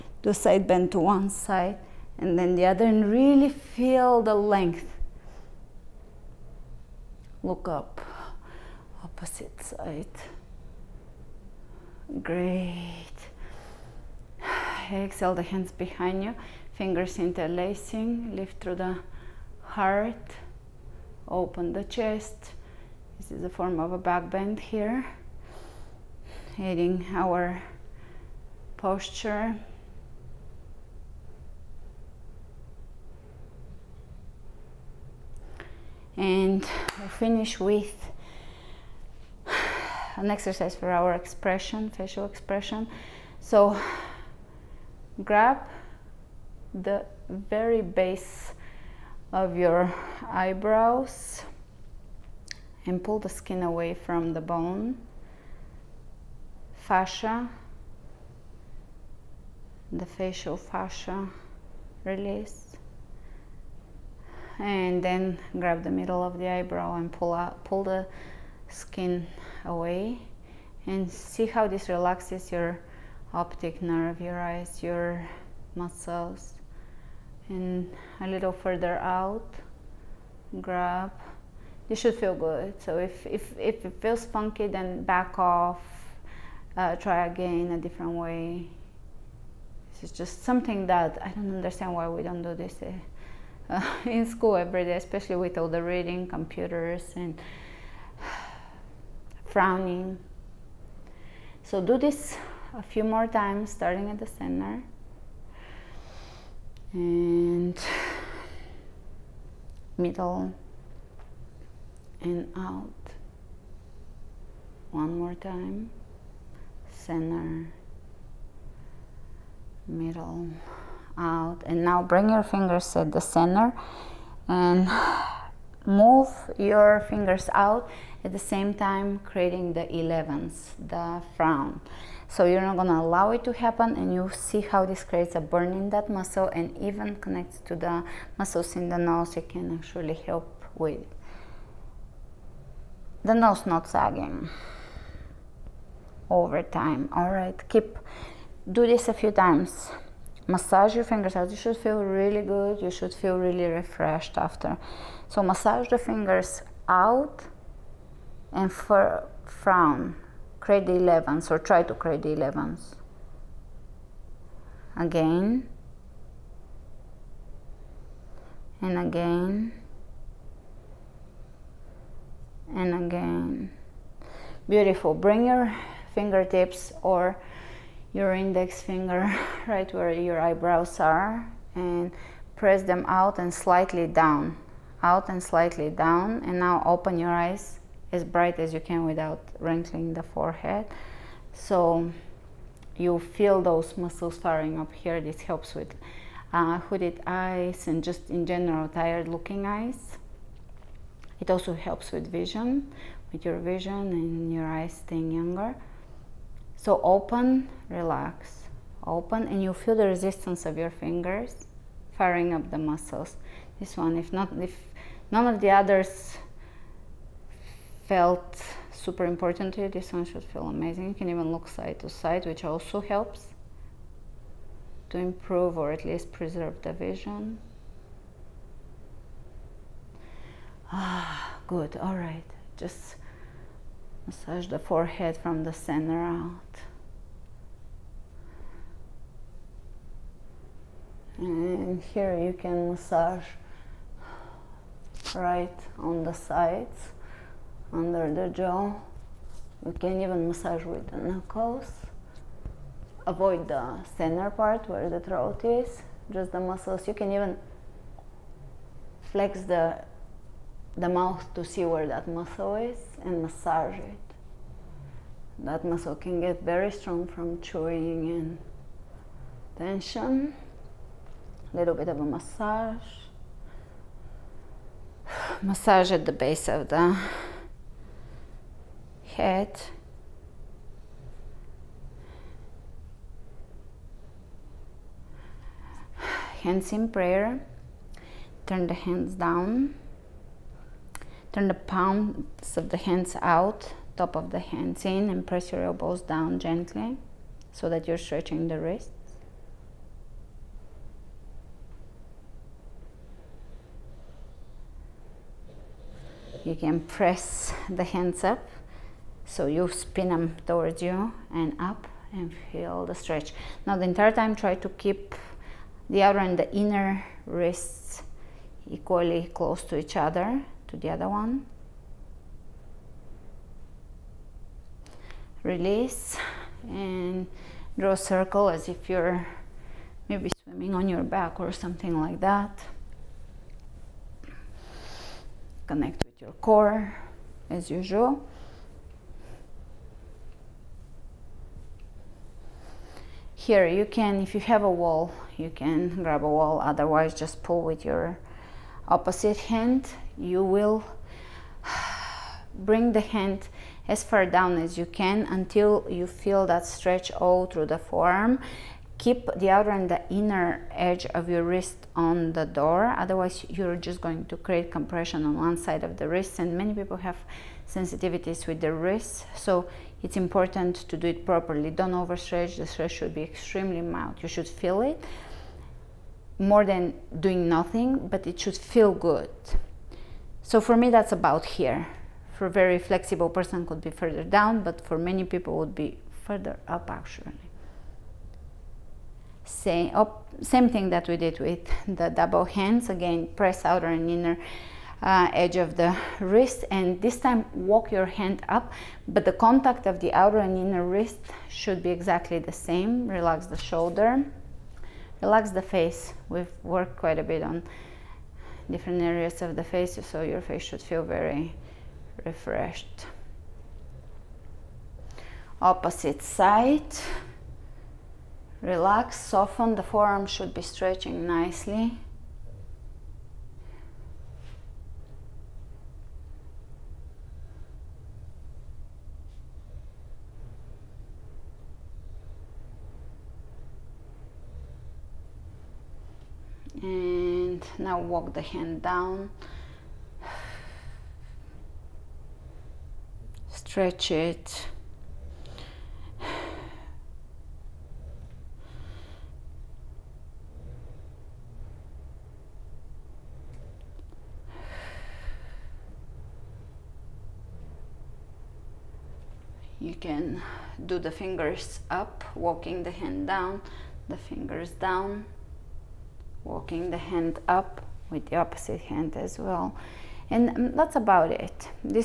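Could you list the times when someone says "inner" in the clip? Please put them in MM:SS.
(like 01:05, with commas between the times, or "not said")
05:16, 06:00, 06:34, 06:40.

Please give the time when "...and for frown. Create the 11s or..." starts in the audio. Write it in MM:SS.
02:38.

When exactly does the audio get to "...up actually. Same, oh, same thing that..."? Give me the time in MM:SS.
06:26.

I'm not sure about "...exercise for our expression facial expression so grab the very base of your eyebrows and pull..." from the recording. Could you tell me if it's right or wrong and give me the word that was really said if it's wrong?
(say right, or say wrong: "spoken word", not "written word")
right.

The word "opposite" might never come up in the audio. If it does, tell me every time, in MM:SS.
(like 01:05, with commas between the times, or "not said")
00:09, 05:49, 06:55, 07:48.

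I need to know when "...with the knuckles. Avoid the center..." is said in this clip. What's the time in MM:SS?
04:10.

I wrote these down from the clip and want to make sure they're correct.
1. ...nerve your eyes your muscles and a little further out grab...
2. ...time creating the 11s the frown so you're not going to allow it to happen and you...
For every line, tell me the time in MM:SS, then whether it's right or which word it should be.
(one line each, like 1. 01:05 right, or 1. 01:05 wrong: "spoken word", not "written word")
1. 01:13 right
2. 02:08 right.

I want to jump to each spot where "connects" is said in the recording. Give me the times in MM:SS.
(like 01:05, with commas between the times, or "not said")
02:17, 05:35.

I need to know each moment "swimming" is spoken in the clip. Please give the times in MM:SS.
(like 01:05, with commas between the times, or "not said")
05:30.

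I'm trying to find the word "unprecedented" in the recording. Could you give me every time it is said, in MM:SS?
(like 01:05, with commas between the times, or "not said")
not said.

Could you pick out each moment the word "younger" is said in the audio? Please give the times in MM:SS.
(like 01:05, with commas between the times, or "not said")
03:25.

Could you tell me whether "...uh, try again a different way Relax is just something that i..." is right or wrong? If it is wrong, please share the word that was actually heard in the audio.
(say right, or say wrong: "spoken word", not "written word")
wrong: "This", not "Relax".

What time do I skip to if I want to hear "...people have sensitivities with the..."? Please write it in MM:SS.
06:06.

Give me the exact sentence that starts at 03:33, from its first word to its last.
This one, if not, if none of the others felt super important to you, this one should feel amazing.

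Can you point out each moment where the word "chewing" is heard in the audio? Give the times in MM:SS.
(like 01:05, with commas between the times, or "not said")
04:27.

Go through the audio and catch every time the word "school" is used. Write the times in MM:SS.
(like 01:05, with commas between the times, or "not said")
01:34.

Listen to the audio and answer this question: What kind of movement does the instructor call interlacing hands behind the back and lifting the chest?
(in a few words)
back bend.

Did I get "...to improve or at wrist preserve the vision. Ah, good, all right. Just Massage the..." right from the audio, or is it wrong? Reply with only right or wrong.
wrong.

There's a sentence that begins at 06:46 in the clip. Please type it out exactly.
We've worked quite a bit on different areas of the face, so your face should feel very refreshed.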